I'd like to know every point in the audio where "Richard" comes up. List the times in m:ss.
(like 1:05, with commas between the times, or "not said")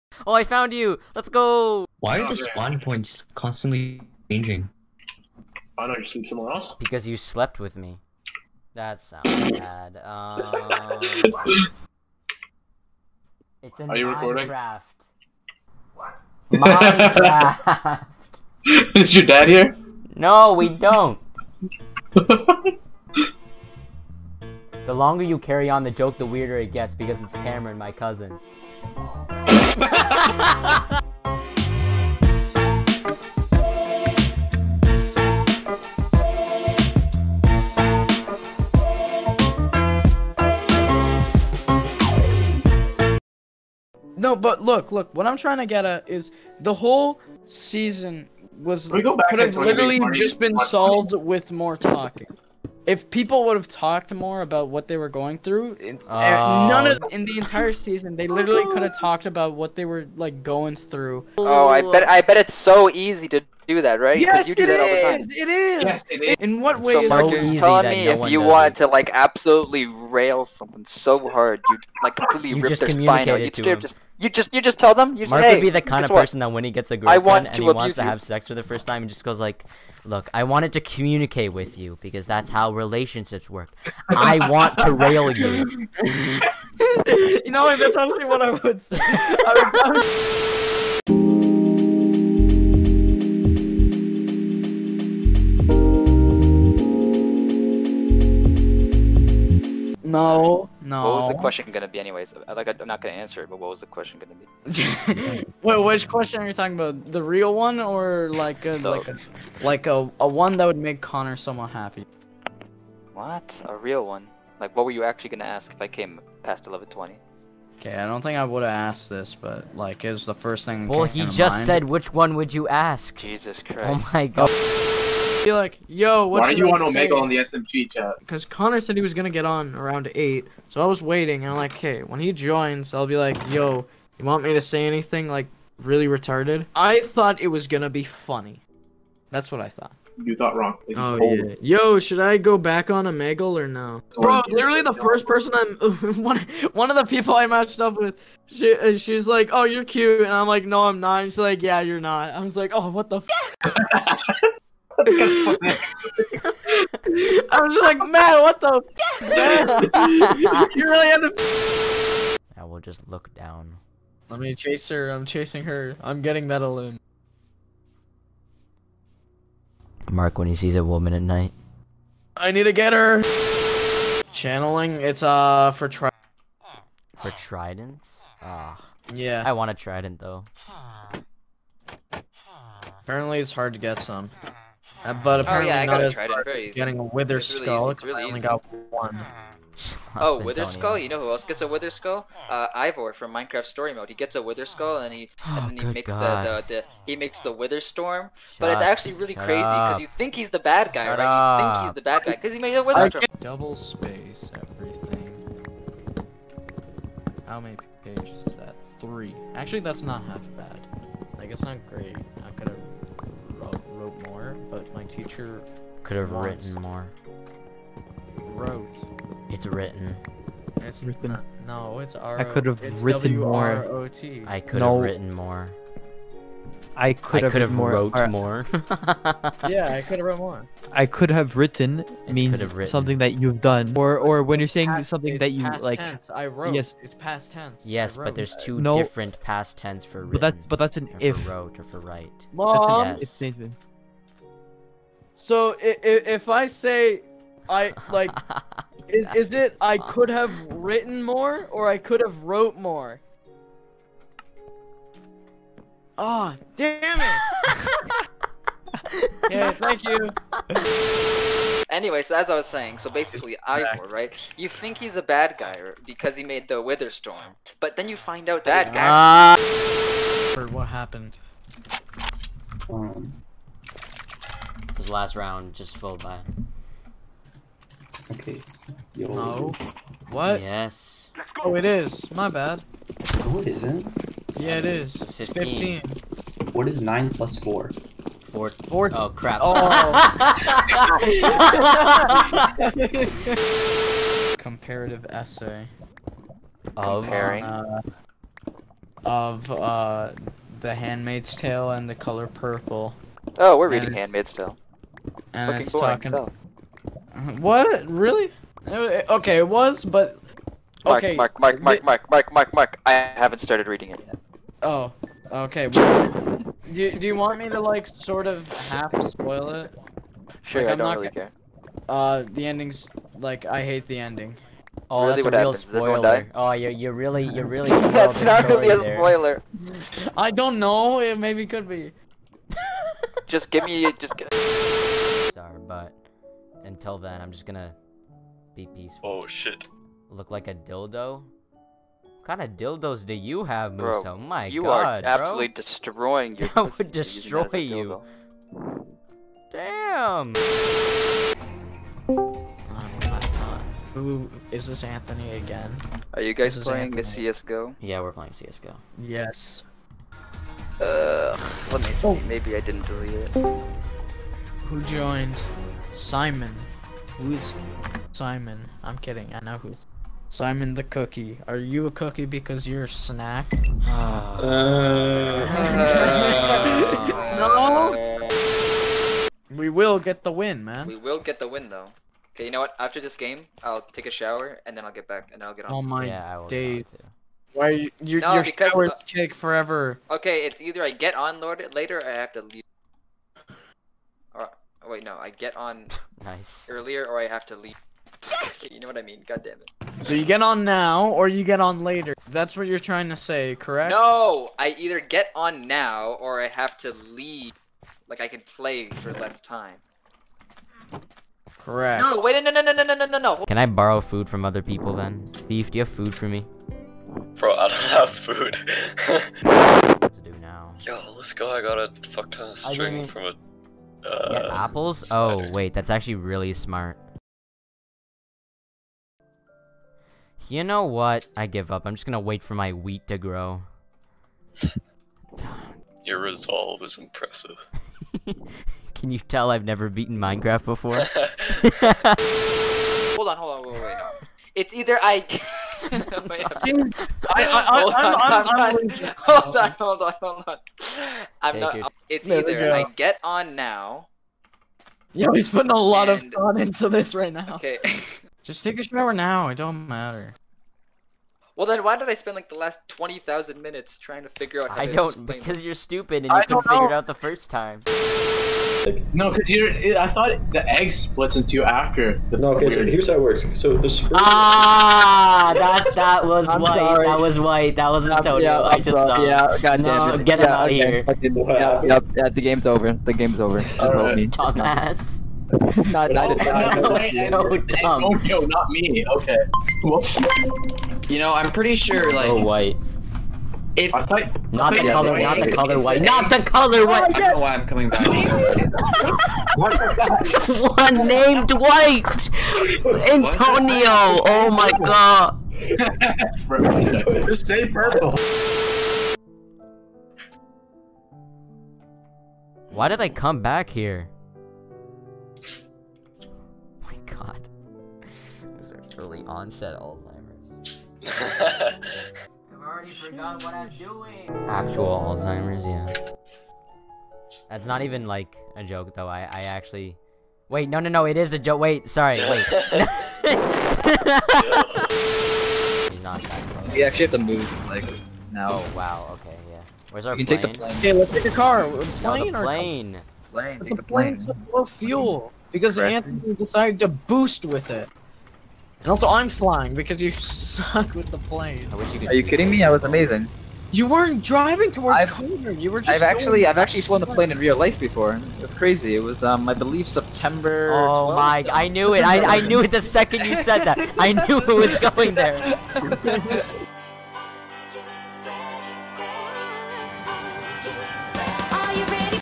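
not said.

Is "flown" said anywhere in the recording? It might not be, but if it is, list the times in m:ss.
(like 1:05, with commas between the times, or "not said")
9:17.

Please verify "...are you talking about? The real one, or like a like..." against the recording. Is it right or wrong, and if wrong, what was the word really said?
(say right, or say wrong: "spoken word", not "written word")
right.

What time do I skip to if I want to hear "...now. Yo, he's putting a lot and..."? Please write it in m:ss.
7:33.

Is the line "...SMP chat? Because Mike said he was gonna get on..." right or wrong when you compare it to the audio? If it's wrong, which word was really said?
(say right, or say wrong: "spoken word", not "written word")
wrong: "Connor", not "Mike".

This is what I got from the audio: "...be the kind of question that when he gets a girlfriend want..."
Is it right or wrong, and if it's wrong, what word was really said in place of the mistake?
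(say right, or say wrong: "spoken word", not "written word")
wrong: "person", not "question".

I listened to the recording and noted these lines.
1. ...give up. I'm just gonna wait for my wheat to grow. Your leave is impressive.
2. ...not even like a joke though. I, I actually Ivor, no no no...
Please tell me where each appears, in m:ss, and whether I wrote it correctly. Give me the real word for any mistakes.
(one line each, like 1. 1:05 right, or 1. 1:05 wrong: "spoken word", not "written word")
1. 7:11 wrong: "resolve", not "leave"
2. 8:47 wrong: "Wait", not "Ivor".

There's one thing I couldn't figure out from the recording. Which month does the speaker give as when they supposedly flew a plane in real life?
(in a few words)
September.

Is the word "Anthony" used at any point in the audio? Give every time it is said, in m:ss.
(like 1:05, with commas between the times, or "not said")
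5:55, 9:05.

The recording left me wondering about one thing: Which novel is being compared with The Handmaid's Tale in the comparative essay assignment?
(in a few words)
The Color Purple.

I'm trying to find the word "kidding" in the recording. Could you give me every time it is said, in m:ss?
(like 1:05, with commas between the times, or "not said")
6:09, 9:12.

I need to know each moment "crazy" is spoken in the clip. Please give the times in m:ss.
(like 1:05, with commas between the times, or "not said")
3:19, 9:18.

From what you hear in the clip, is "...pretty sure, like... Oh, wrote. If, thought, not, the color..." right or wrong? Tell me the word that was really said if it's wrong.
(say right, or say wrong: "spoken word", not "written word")
wrong: "white", not "wrote".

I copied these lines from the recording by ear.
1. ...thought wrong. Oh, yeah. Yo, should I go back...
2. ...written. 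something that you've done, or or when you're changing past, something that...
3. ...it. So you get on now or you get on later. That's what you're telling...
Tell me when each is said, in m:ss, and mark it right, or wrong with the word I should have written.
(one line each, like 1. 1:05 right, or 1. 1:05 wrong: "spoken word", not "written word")
1. 2:20 right
2. 3:52 wrong: "saying", not "changing"
3. 6:39 wrong: "trying", not "telling".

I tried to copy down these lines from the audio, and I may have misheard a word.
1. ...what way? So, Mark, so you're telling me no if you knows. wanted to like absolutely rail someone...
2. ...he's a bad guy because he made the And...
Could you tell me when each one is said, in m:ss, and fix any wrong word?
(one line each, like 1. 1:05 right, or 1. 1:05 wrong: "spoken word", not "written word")
1. 1:06 right
2. 4:24 wrong: "Wither", not "And".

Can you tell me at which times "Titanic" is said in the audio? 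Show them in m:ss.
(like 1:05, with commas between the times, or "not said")
not said.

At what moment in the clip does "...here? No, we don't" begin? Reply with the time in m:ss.
0:19.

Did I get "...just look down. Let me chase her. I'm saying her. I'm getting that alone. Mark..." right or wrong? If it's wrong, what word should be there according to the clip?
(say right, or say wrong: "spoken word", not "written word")
wrong: "chasing", not "saying".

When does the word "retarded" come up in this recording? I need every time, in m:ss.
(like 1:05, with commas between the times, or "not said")
2:16.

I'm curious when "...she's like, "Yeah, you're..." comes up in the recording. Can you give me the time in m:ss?
2:31.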